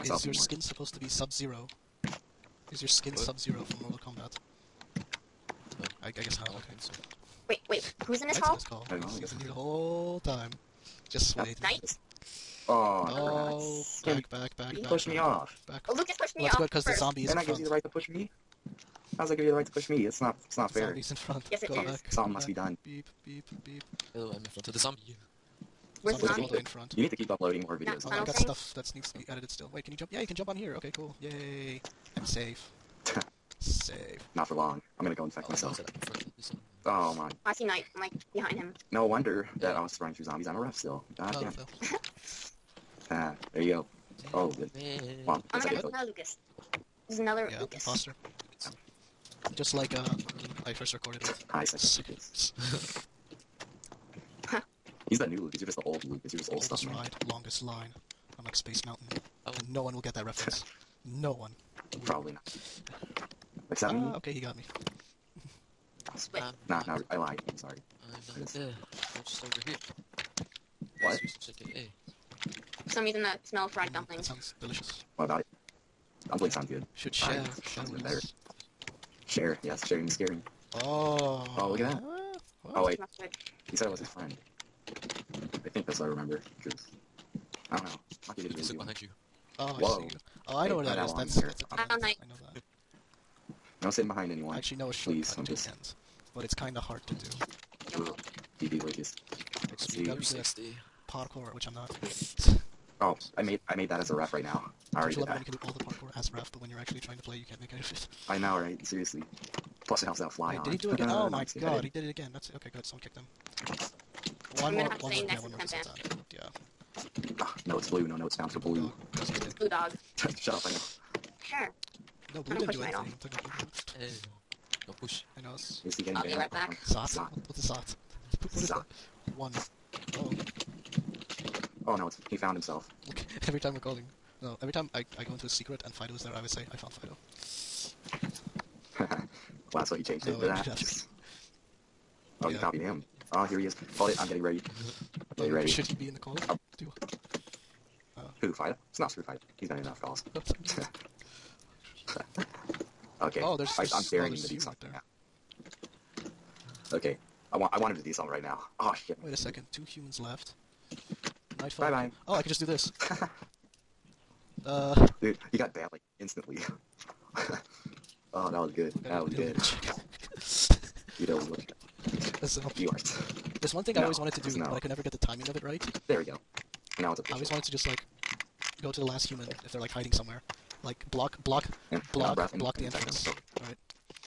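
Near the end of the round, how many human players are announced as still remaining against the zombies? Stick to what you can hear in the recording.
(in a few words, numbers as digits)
2.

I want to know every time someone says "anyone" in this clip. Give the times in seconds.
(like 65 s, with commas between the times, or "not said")
94 s.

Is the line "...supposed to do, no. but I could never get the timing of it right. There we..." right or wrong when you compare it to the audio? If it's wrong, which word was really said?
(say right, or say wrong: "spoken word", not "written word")
wrong: "wanted", not "supposed".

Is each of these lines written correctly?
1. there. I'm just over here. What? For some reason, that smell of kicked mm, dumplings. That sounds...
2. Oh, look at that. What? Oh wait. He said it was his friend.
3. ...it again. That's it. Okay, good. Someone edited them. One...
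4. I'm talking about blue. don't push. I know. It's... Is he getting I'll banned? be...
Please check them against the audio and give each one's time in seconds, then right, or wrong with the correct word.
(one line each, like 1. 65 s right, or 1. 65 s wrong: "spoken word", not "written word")
1. 68 s wrong: "fried", not "kicked"
2. 81 s right
3. 112 s wrong: "kicked", not "edited"
4. 122 s right.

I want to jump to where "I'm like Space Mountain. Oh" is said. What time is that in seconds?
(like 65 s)
58 s.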